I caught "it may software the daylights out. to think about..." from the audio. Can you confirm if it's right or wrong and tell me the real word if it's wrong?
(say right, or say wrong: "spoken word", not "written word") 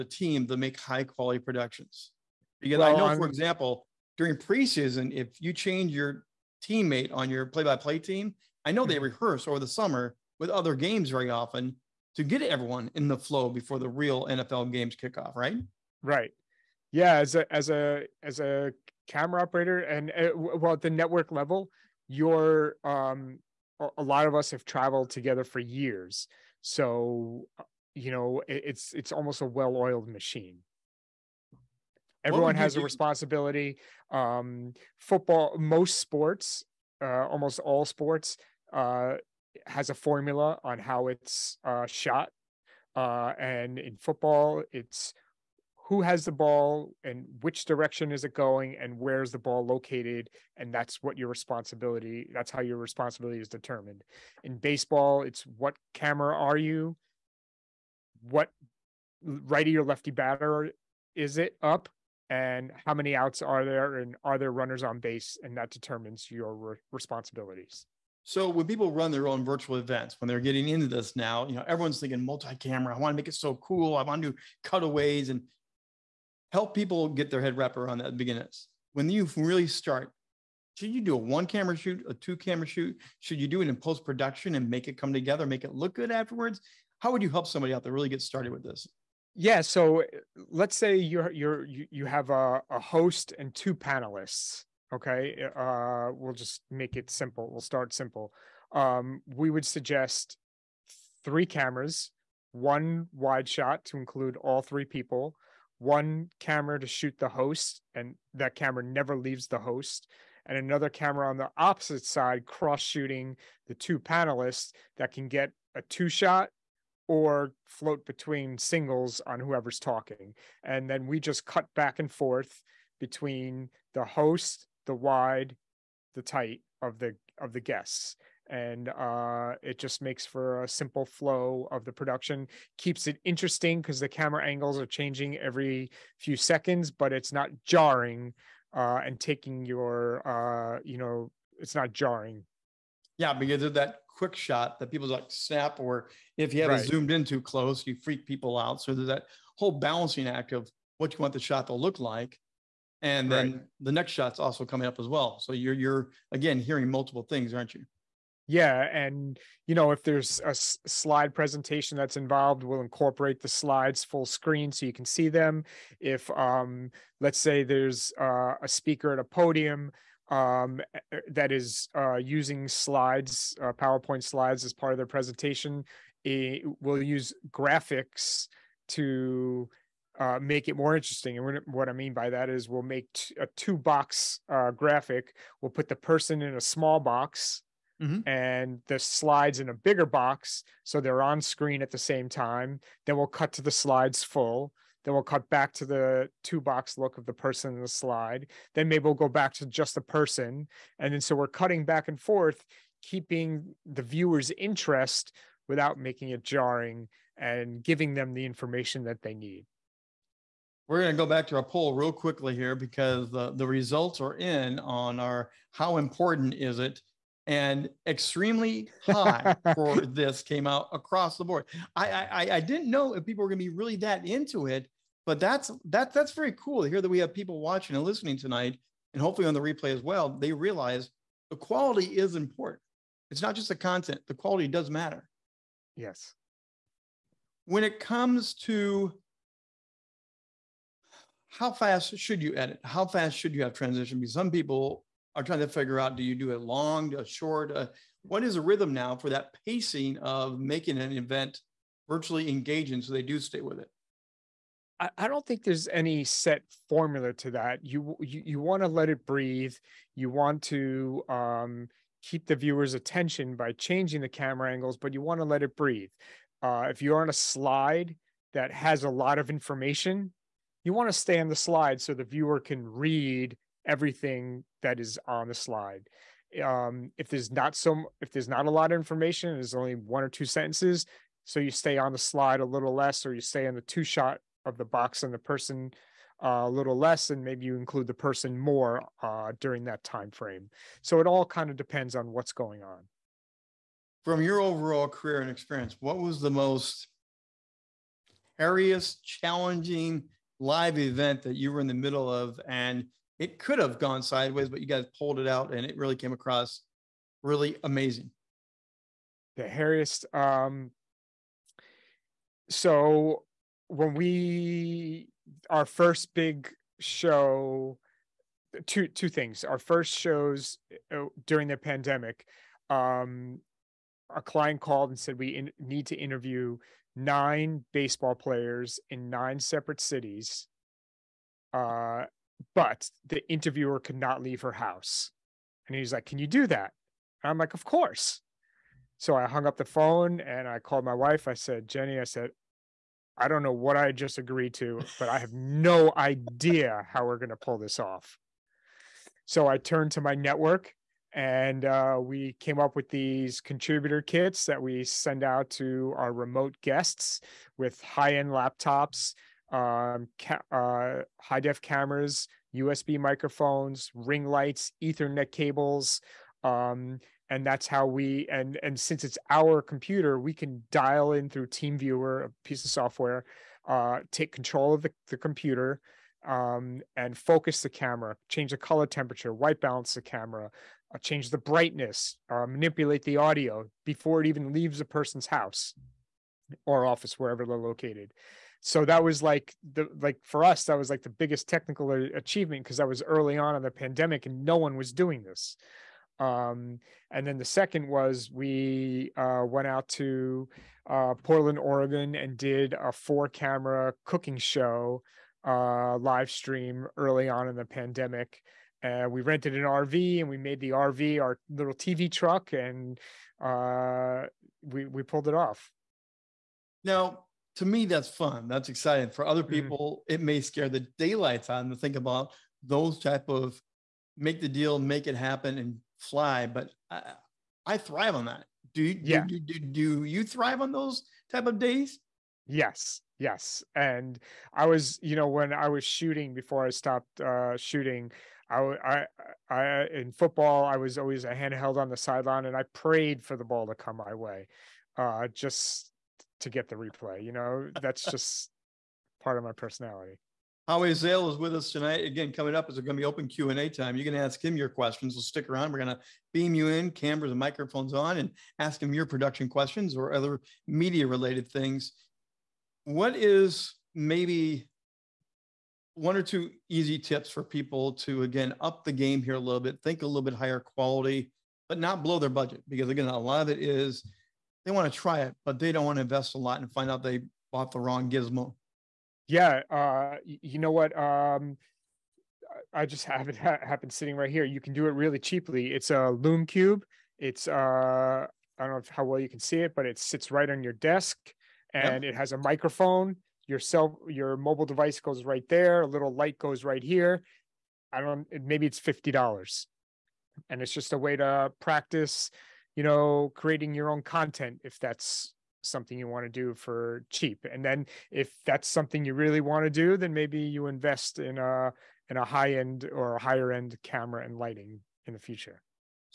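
wrong: "scare", not "software".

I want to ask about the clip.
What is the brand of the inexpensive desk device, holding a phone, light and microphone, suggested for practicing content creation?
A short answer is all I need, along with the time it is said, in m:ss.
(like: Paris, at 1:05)
Lume Cube, at 8:06.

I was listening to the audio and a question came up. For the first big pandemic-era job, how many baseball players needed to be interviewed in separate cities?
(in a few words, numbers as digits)
9.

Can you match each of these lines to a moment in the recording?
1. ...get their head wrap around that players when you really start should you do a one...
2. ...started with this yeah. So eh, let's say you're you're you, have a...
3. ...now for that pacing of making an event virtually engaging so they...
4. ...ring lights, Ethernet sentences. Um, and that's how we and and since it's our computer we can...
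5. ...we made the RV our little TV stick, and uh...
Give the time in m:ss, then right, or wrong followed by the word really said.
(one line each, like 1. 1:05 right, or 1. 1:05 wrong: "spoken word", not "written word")
1. 1:17 wrong: "beginners", not "players"
2. 1:28 right
3. 4:08 right
4. 6:04 wrong: "cables", not "sentences"
5. 6:50 wrong: "truck", not "stick".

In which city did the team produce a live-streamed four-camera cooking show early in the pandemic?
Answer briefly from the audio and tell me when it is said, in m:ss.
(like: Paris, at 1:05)
Portland, Oregon, at 6:41.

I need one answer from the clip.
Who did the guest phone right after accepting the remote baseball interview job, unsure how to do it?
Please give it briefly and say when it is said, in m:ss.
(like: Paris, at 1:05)
Jenny, at 5:41.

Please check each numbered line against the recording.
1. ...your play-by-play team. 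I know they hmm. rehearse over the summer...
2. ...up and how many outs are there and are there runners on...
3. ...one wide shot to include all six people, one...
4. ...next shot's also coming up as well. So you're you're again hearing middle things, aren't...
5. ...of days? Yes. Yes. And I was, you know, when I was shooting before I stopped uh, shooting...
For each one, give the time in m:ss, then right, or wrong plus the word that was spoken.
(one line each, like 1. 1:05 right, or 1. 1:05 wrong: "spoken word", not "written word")
1. 0:07 right
2. 1:01 right
3. 1:42 wrong: "three", not "six"
4. 2:33 wrong: "multiple", not "middle"
5. 7:11 right.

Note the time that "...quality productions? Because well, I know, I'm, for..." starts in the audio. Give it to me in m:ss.
0:01.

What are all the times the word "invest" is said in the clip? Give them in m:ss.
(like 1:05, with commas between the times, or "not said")
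7:56, 8:30.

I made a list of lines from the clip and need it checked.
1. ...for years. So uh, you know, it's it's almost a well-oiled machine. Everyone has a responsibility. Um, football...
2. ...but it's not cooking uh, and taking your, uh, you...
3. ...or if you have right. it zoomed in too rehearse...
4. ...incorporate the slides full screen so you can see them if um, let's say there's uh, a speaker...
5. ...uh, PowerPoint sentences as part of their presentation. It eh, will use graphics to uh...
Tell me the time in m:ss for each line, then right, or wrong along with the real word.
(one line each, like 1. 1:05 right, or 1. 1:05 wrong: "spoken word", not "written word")
1. 0:25 right
2. 2:16 wrong: "jarring", not "cooking"
3. 2:25 wrong: "close", not "rehearse"
4. 2:42 right
5. 2:53 wrong: "slides", not "sentences".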